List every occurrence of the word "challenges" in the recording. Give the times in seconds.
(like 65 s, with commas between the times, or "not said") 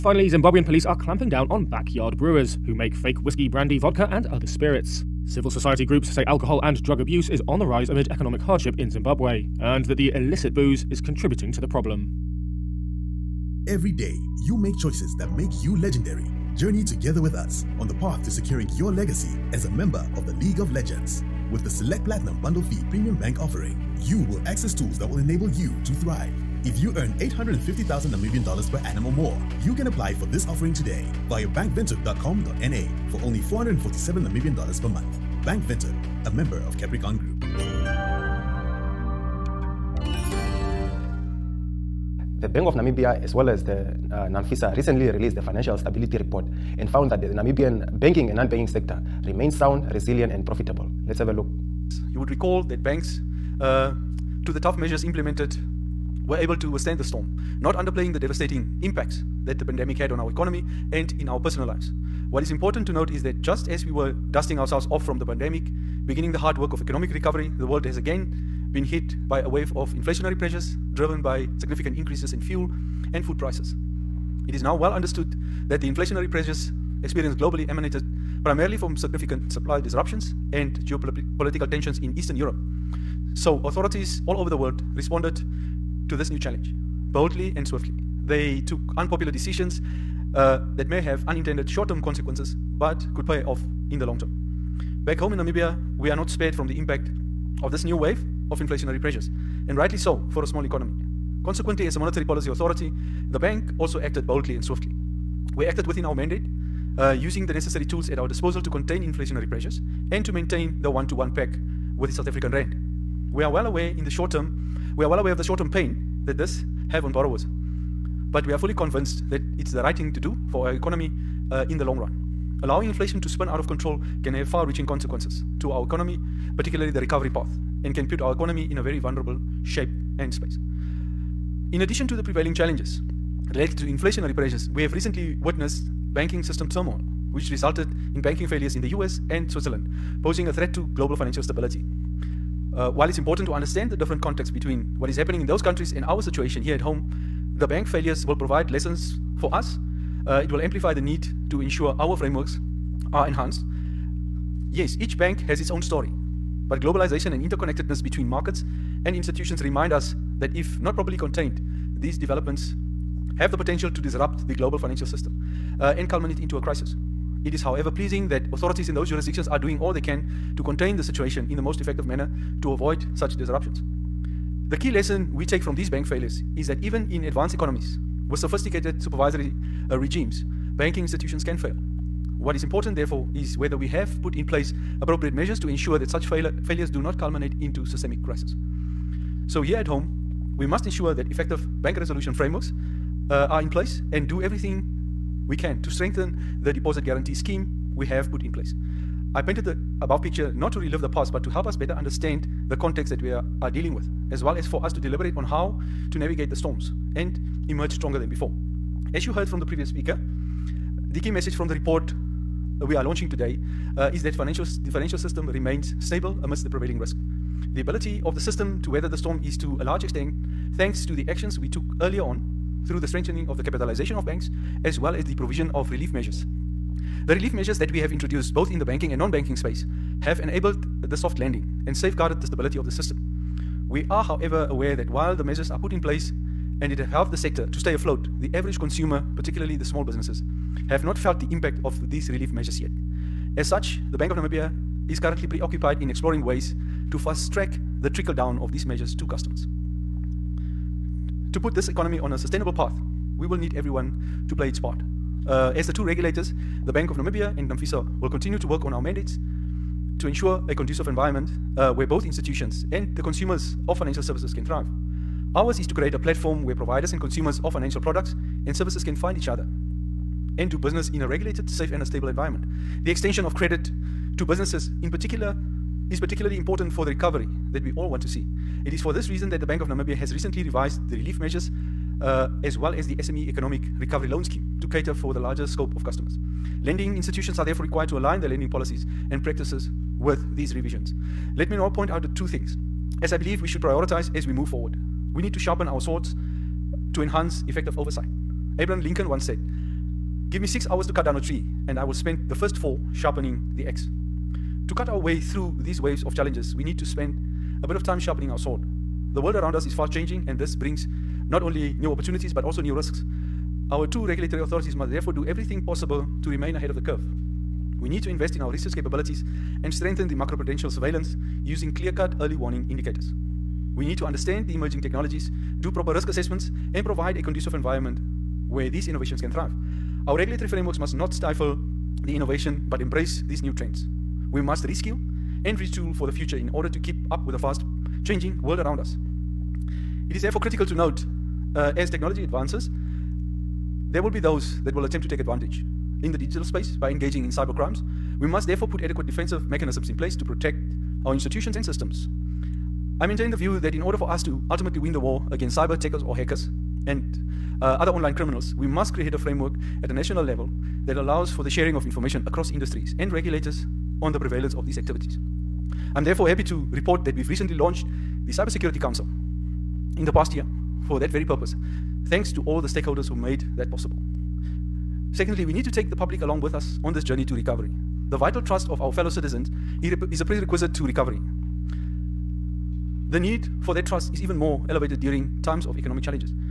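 86 s, 132 s, 306 s.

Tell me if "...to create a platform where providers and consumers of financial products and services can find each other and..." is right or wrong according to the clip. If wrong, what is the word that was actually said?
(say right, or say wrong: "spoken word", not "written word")
right.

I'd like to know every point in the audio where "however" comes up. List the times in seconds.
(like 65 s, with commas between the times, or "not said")
167 s, 234 s.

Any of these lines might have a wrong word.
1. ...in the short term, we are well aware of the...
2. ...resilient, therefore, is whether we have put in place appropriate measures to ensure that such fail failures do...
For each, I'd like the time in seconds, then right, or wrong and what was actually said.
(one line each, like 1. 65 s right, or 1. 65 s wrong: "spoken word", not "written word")
1. 113 s right
2. 182 s wrong: "important", not "resilient".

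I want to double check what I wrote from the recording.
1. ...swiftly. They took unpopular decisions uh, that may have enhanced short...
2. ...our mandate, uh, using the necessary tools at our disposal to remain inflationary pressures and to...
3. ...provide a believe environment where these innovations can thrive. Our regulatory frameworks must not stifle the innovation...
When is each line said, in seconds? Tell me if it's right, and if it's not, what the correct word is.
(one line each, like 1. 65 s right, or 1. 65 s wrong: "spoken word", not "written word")
1. 87 s wrong: "unintended", not "enhanced"
2. 106 s wrong: "contain", not "remain"
3. 327 s wrong: "conducive", not "believe".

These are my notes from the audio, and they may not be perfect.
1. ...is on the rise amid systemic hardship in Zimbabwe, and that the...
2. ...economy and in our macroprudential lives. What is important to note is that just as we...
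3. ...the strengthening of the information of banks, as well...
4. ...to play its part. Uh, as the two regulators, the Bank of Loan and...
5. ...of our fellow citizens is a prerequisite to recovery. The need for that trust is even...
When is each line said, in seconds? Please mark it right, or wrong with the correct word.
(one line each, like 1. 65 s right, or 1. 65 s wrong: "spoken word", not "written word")
1. 7 s wrong: "economic", not "systemic"
2. 60 s wrong: "personal", not "macroprudential"
3. 222 s wrong: "capitalization", not "information"
4. 254 s wrong: "Namibia", not "Loan"
5. 378 s right.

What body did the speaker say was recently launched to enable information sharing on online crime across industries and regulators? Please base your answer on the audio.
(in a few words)
Cybersecurity Council.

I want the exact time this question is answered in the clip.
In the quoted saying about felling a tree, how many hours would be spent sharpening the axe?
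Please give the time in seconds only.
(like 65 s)
302 s.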